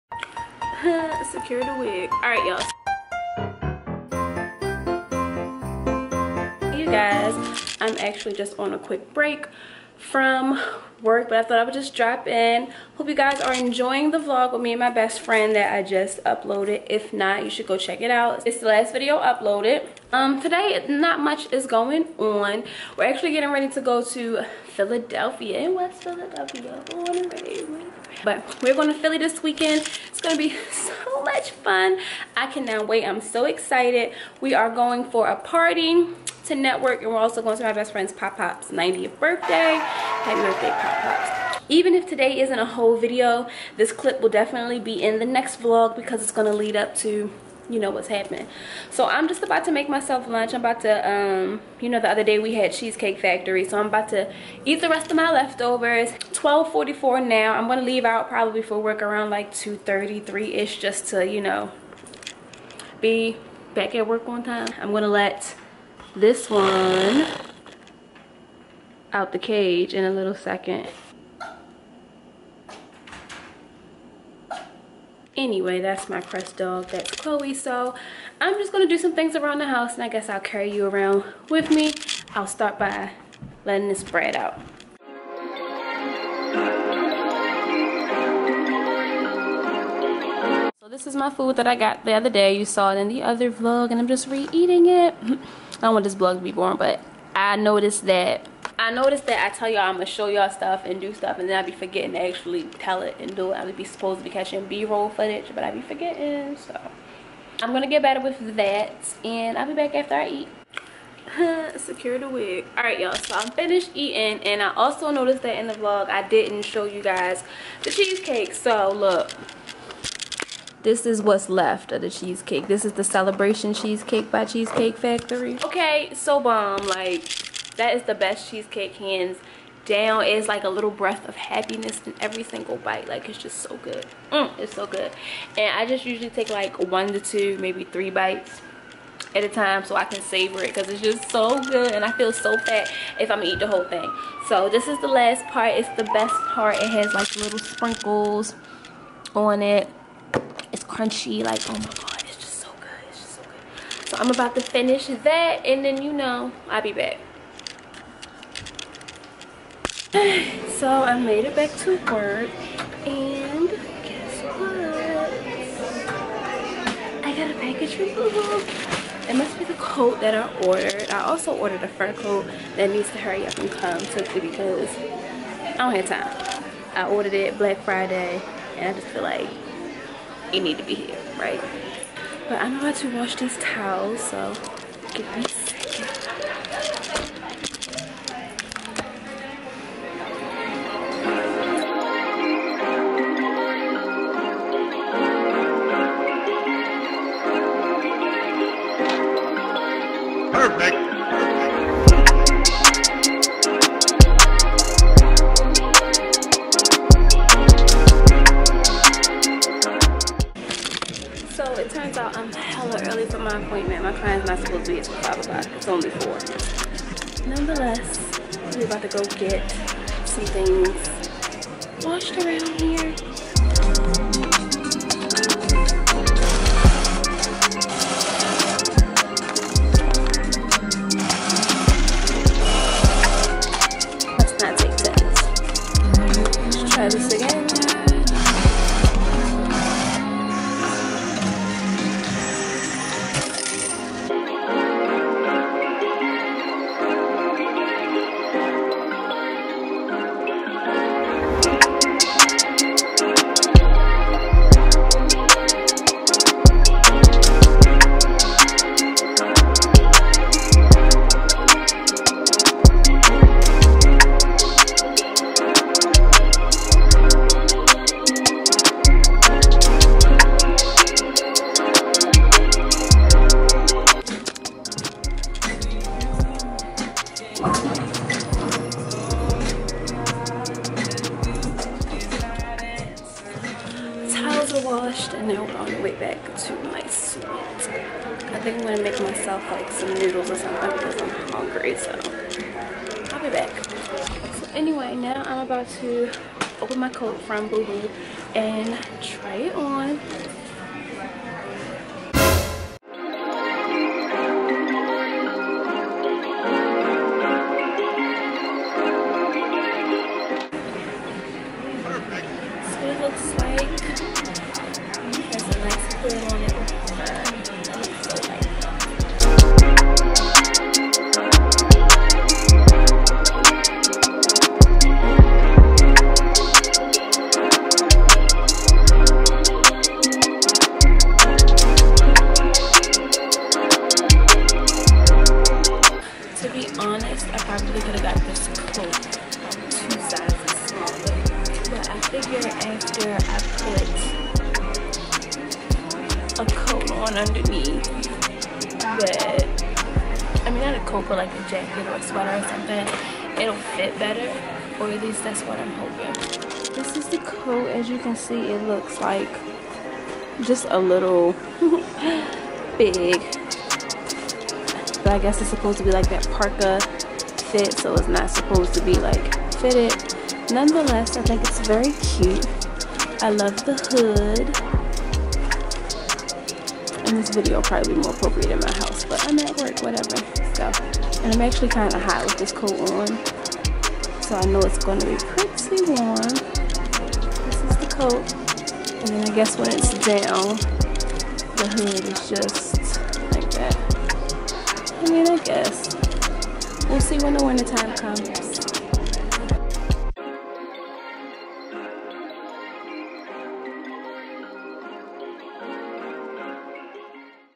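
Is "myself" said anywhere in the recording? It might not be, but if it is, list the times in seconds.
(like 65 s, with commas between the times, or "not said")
49 s, 289 s.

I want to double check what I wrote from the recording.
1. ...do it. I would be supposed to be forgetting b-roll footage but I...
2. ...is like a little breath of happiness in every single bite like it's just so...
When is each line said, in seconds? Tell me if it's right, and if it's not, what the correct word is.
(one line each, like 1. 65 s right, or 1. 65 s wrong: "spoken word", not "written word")
1. 103 s wrong: "catching", not "forgetting"
2. 130 s right.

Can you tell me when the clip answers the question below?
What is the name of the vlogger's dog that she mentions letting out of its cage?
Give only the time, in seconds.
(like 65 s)
76 s.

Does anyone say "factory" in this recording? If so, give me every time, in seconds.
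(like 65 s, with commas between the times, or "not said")
53 s, 124 s.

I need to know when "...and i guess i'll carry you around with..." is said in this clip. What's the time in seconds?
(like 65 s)
79 s.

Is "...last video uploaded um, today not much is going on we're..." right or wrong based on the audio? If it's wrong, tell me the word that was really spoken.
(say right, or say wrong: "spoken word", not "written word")
right.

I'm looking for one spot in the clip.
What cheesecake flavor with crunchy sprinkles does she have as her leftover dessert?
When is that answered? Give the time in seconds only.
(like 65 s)
123 s.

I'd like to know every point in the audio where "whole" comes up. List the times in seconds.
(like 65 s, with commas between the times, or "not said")
42 s, 143 s.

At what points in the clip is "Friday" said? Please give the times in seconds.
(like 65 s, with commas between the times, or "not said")
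177 s.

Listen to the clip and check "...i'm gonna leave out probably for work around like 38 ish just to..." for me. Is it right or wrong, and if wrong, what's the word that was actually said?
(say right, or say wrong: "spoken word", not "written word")
wrong: "33", not "38".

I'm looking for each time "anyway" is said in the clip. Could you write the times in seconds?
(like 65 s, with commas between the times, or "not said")
75 s, 294 s.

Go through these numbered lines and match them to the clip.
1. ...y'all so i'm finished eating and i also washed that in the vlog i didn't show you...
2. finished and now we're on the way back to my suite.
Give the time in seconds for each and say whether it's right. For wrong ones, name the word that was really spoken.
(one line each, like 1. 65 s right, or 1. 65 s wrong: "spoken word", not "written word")
1. 112 s wrong: "noticed", not "washed"
2. 284 s wrong: "washed", not "finished".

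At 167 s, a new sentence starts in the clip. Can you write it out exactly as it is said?
I got a package from Google.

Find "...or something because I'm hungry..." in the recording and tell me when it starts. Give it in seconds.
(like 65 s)
290 s.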